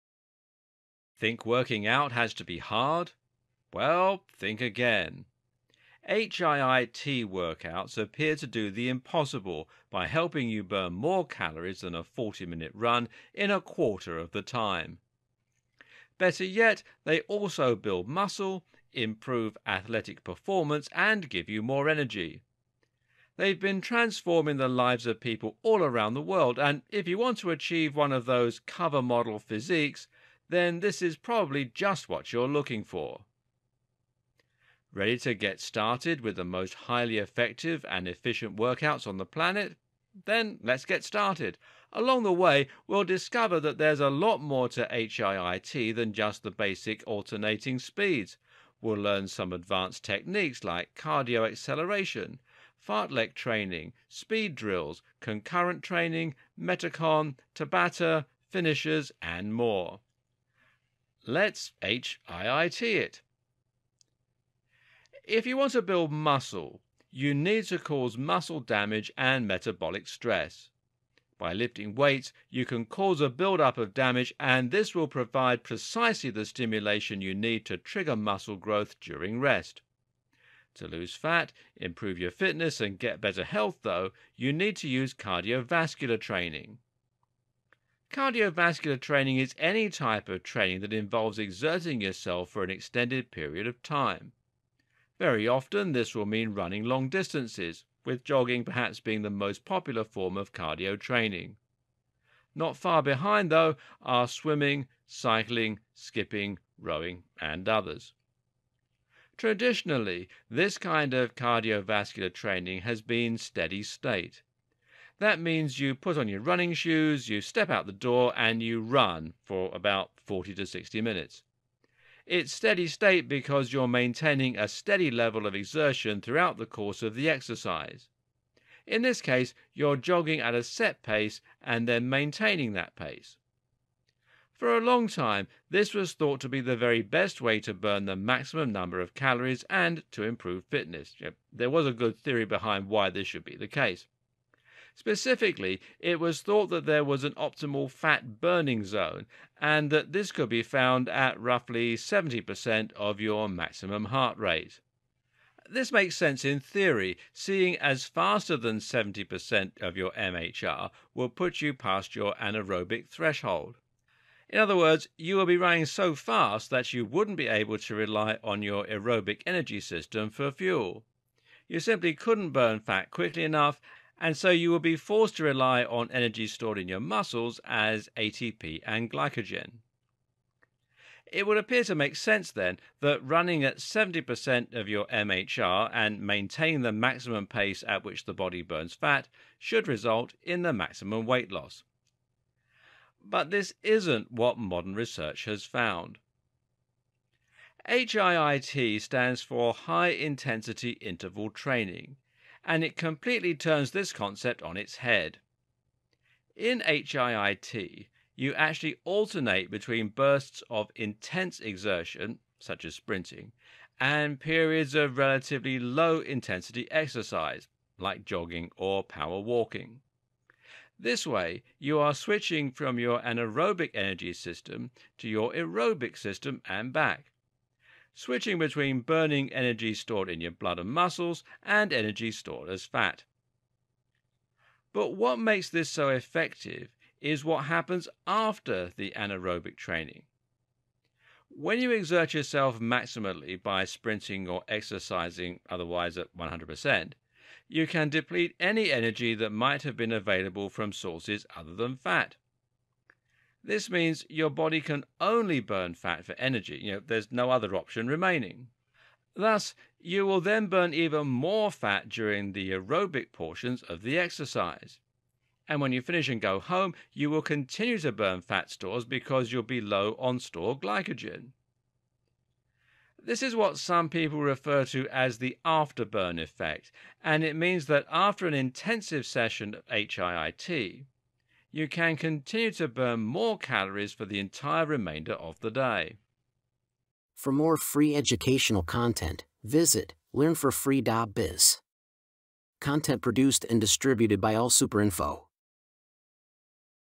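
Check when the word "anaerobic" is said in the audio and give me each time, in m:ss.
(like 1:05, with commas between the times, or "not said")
2:42, 3:43, 3:59.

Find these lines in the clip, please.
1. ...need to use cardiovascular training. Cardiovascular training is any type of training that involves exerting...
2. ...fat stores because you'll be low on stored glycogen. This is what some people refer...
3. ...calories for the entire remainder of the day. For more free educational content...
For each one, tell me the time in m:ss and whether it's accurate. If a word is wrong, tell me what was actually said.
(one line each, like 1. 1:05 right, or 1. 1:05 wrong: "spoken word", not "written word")
1. 1:24 right
2. 4:28 right
3. 4:43 right.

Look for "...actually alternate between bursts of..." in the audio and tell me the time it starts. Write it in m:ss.
3:28.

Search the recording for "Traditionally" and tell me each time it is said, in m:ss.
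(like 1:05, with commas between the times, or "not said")
1:49.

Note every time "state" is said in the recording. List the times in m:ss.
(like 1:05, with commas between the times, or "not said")
1:53, 2:02.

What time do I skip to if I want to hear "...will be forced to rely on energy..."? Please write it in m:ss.
2:54.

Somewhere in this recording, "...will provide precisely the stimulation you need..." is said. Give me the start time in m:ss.
1:14.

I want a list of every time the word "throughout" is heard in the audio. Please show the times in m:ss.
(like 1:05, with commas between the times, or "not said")
2:06.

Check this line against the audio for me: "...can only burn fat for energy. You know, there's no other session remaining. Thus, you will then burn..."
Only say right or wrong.
wrong.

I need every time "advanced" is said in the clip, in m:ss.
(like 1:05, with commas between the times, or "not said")
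0:49.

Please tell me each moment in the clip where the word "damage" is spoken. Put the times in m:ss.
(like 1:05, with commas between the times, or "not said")
1:08, 1:13.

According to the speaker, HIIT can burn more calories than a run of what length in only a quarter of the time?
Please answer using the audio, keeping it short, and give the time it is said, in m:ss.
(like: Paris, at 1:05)
40 minute, at 0:12.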